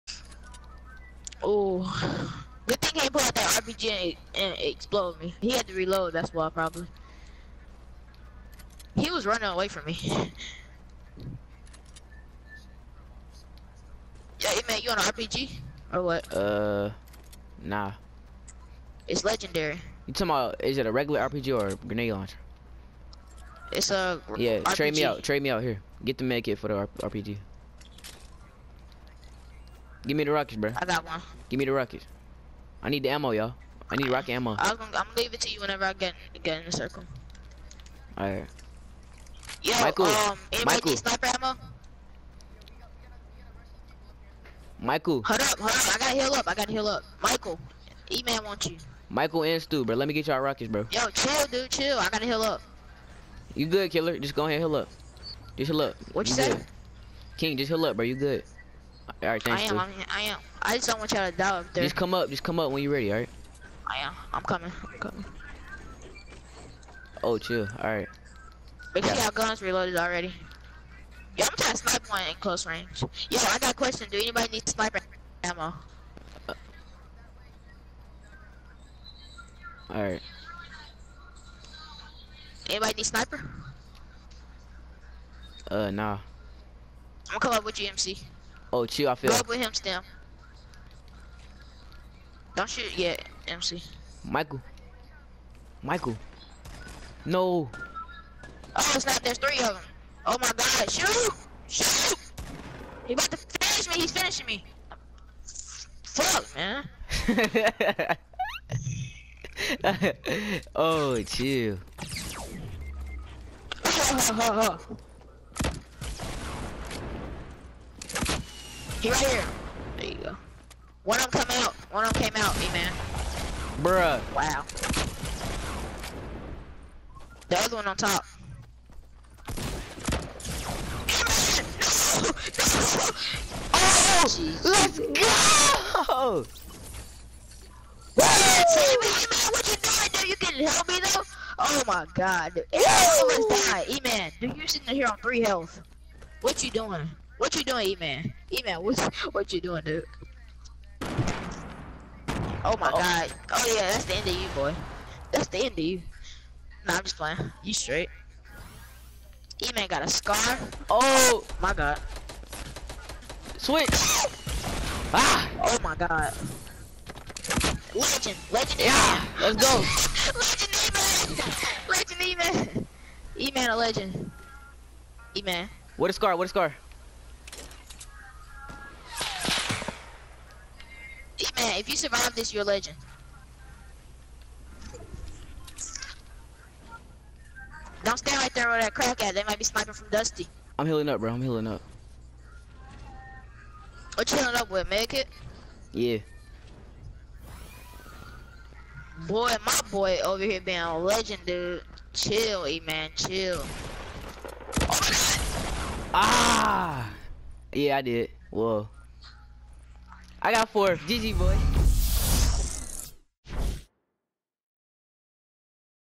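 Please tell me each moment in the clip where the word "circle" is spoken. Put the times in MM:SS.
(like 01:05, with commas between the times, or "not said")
00:36.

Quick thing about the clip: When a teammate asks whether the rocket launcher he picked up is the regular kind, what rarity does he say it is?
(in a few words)
legendary.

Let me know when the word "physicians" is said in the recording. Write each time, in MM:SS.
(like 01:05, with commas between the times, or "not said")
not said.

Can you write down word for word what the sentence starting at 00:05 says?
He had to reload, that's why probably.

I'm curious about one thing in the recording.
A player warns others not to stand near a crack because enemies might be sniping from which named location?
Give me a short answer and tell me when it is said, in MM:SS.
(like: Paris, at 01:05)
Dusty, at 03:10.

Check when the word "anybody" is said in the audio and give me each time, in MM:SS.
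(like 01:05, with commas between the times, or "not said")
01:14, 01:22.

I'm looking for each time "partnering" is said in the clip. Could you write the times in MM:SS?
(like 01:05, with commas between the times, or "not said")
not said.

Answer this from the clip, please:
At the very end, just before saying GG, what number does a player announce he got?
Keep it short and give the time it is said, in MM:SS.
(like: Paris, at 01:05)
4, at 03:30.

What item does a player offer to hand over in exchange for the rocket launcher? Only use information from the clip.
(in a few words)
med kit.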